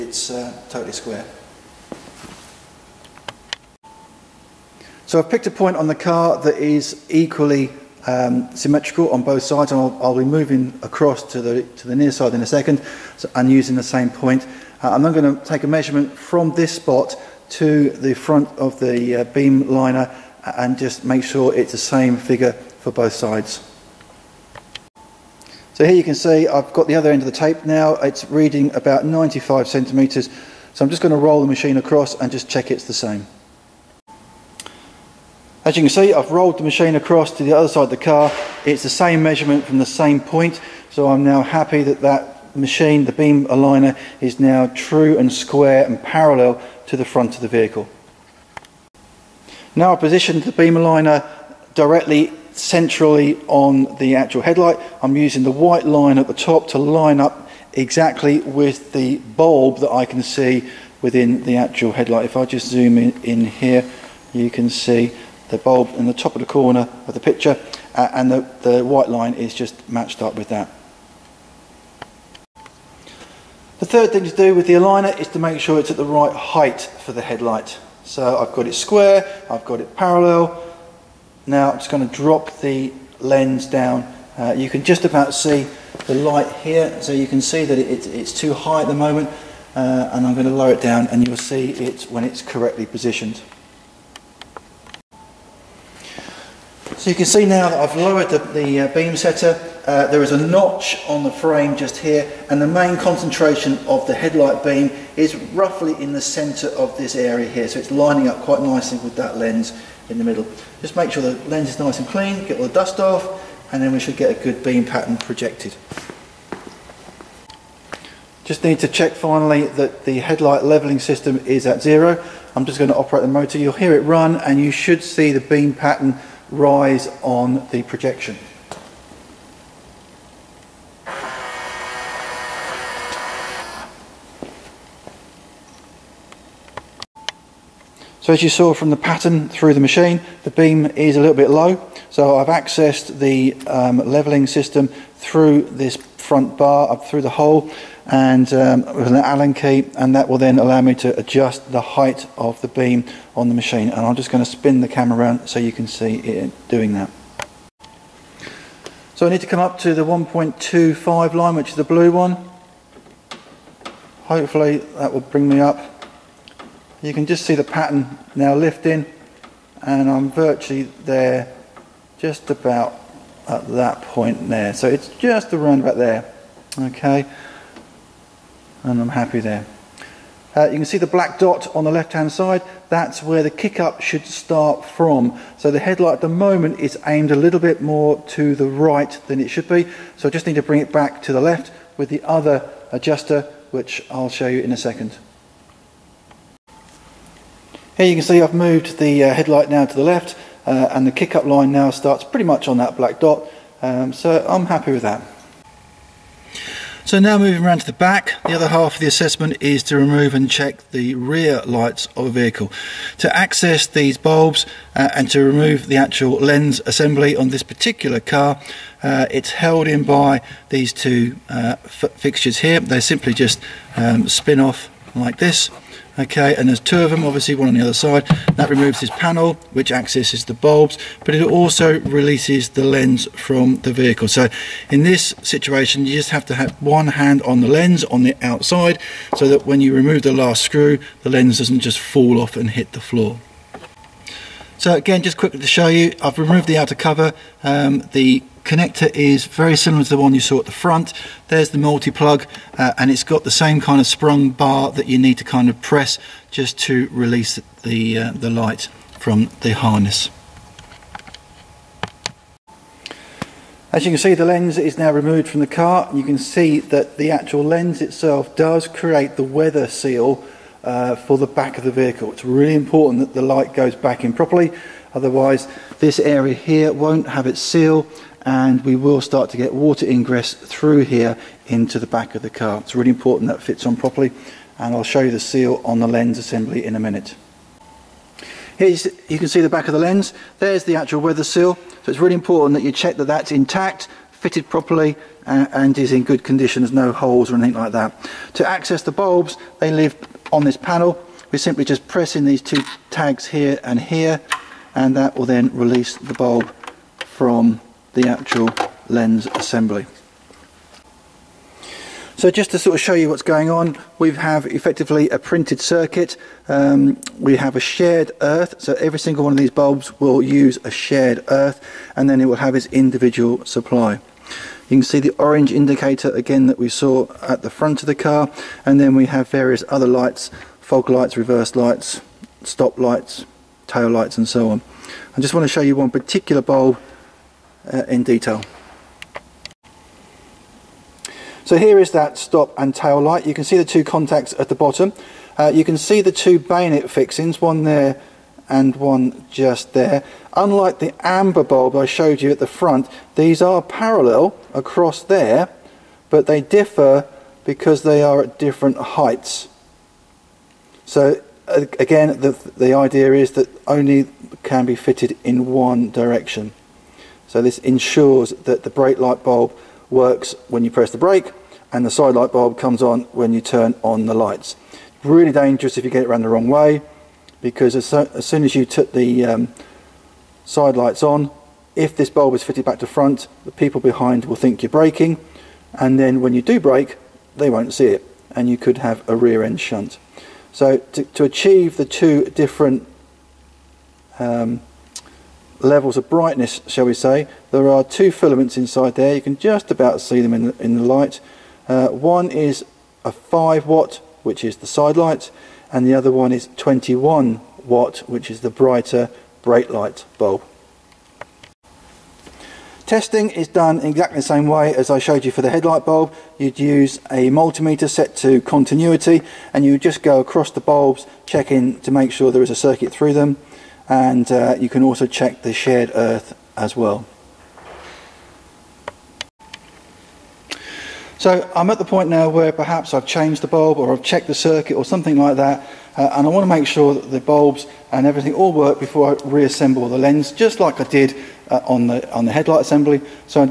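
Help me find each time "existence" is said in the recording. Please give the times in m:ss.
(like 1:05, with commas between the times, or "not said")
not said.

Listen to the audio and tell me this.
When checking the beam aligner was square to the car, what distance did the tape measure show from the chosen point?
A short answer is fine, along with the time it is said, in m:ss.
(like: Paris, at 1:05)
95 centimetres, at 0:29.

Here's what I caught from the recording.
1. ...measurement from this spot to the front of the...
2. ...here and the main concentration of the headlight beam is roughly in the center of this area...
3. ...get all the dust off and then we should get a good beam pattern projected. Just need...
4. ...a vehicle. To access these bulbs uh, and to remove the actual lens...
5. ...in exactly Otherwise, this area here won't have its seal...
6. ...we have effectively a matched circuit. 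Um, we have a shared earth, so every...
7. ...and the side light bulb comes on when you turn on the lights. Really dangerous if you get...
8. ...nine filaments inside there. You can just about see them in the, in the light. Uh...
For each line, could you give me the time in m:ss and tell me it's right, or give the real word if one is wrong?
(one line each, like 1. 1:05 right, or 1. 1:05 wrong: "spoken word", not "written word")
1. 0:15 right
2. 1:41 right
3. 1:52 right
4. 3:32 right
5. 4:34 wrong: "properly", not "exactly"
6. 5:14 wrong: "printed", not "matched"
7. 6:11 right
8. 6:38 wrong: "two", not "nine".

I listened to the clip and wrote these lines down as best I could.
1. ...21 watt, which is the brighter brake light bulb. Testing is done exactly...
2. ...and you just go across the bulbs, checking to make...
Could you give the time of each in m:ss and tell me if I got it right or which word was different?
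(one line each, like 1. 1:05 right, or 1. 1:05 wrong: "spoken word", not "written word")
1. 6:46 right
2. 6:59 right.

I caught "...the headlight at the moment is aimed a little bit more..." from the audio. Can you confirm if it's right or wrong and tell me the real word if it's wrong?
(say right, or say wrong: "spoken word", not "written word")
right.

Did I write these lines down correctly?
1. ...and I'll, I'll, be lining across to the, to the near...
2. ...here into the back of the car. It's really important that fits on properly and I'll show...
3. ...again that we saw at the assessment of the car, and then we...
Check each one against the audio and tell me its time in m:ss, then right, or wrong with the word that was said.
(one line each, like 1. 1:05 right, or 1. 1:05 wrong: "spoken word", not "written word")
1. 0:09 wrong: "moving", not "lining"
2. 4:41 right
3. 5:26 wrong: "front", not "assessment".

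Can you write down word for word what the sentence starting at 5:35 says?
I just want to show you one particular bulb uh, in detail.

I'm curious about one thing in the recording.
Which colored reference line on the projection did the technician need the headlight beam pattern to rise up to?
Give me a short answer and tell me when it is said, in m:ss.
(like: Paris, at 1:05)
blue, at 2:41.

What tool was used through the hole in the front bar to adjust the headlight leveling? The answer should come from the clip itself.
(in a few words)
Allen key.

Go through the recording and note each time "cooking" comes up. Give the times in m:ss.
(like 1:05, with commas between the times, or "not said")
not said.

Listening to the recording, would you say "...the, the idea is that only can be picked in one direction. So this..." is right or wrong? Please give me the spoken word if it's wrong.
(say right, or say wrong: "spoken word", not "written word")
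wrong: "fitted", not "picked".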